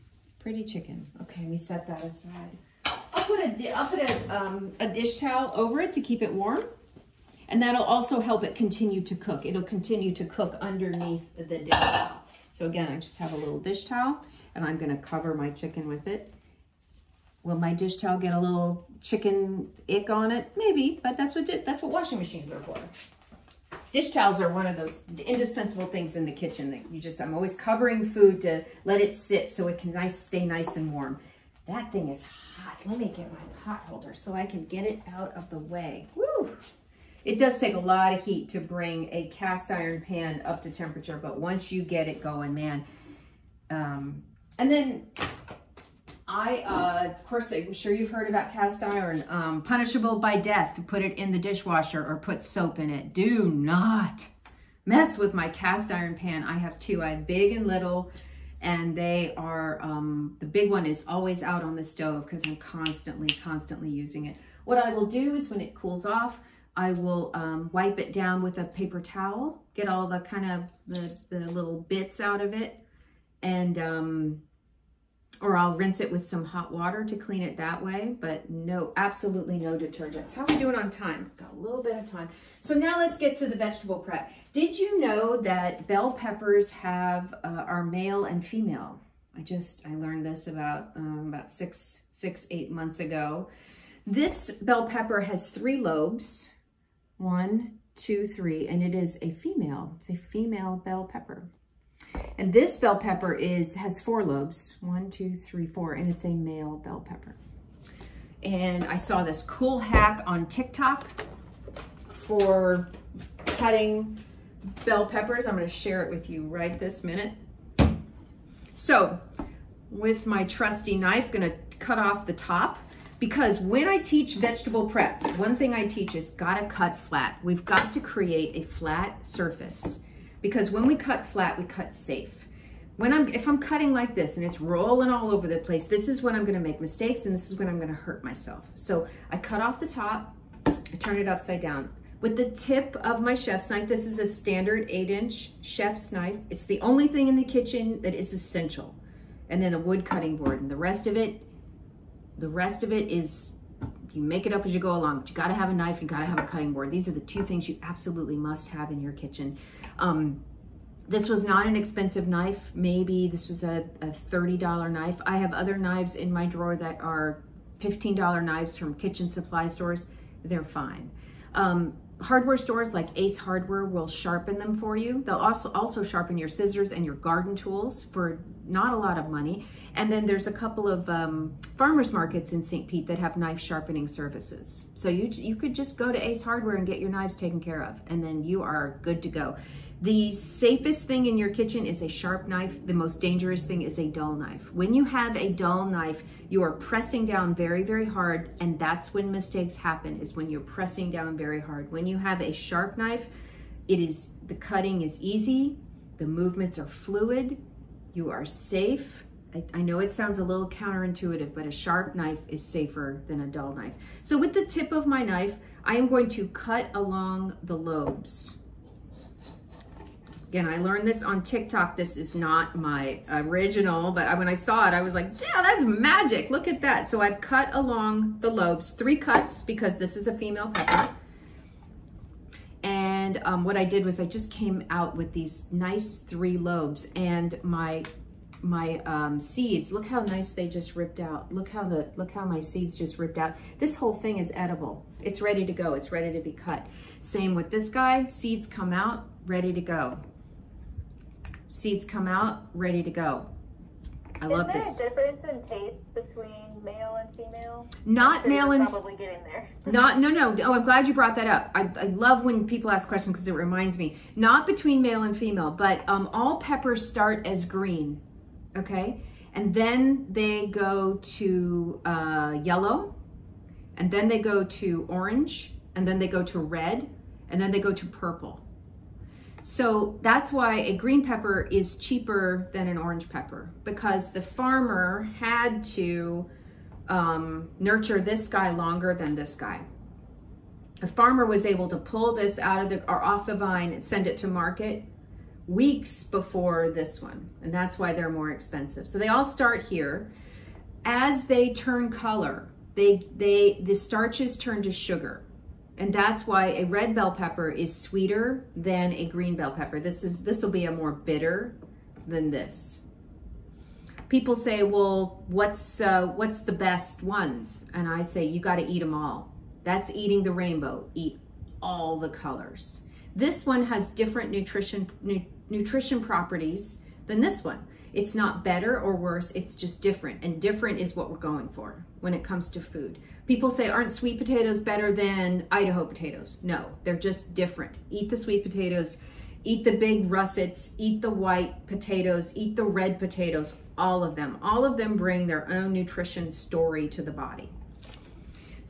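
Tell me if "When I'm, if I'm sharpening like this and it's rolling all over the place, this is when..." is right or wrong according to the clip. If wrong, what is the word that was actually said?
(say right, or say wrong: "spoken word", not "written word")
wrong: "cutting", not "sharpening".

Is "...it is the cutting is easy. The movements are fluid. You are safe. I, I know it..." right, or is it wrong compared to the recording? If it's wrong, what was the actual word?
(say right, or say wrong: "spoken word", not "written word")
right.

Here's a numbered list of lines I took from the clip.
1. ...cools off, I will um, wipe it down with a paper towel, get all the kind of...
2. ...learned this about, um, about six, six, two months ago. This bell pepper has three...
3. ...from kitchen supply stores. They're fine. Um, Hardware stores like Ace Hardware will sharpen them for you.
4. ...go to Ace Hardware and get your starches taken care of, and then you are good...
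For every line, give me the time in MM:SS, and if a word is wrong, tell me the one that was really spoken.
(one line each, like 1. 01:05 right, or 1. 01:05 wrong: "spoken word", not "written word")
1. 01:05 right
2. 01:29 wrong: "eight", not "two"
3. 02:48 right
4. 03:05 wrong: "knives", not "starches".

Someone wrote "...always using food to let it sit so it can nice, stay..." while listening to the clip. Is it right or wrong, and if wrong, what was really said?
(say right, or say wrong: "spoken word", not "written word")
wrong: "covering", not "using".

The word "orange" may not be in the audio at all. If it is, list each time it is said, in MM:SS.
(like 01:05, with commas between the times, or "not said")
04:35, 04:42.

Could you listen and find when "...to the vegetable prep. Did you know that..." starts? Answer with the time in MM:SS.
01:23.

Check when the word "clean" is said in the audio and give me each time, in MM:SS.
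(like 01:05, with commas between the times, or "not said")
01:17.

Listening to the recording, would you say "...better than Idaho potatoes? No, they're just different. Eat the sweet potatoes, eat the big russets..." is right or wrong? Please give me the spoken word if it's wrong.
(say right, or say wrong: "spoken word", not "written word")
right.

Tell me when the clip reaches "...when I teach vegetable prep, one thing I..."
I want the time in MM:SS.
02:03.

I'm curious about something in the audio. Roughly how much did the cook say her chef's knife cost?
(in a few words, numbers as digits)
$30.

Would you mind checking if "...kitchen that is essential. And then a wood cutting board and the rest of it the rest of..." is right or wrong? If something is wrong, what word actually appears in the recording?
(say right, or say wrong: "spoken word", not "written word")
right.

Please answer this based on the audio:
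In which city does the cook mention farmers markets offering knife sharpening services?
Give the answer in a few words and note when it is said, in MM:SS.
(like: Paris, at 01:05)
St. Pete, at 03:02.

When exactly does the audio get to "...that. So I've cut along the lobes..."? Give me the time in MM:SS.
03:46.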